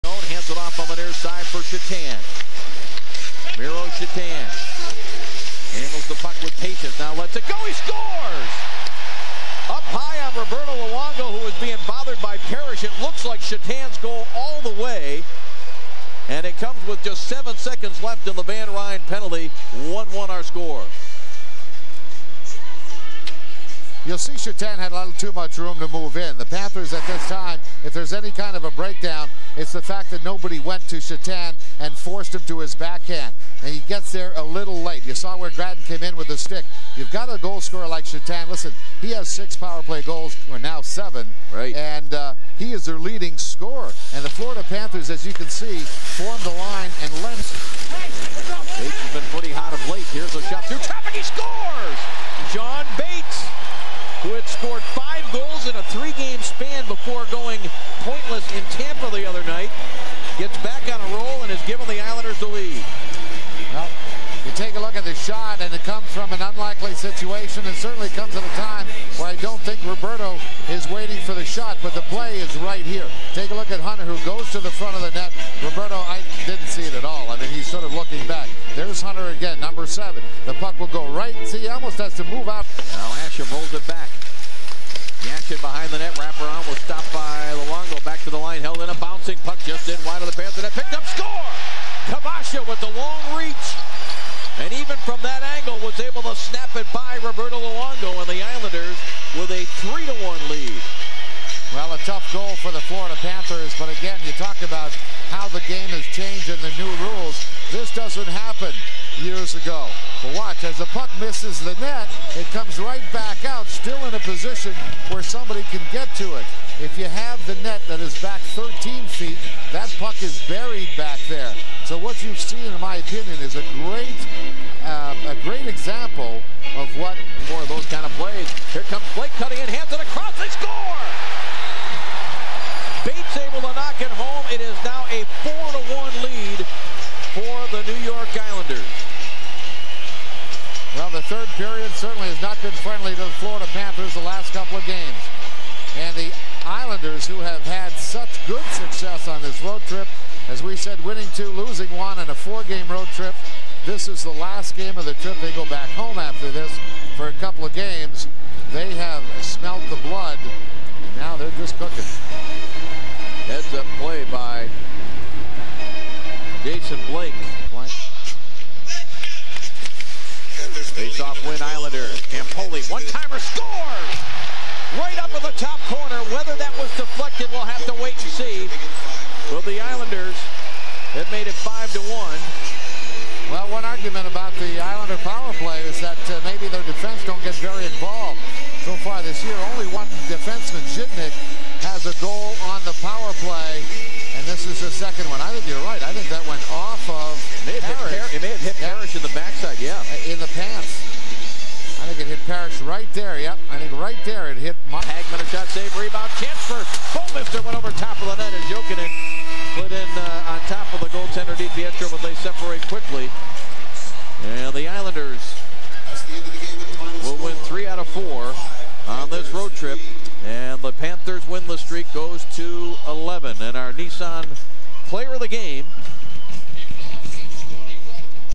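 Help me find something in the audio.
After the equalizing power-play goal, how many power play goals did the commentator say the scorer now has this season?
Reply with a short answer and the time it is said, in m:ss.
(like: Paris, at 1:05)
7, at 0:40.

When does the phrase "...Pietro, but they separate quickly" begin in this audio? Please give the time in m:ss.
3:31.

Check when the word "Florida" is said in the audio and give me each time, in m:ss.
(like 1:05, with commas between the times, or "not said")
0:44, 1:42, 2:23.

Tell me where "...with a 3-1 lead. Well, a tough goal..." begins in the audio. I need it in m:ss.
1:39.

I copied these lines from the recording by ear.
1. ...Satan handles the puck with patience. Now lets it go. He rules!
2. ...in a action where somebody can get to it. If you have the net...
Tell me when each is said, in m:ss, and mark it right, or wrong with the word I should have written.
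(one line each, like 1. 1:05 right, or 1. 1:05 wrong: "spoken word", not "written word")
1. 0:03 wrong: "scores", not "rules"
2. 1:54 wrong: "position", not "action".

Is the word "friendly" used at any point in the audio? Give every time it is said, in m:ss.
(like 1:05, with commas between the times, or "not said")
2:22.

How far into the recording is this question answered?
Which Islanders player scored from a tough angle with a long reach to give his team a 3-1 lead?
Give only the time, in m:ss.
1:32.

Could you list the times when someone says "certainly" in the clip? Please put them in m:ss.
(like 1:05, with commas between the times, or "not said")
1:07, 2:21.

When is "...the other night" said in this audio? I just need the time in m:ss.
0:59.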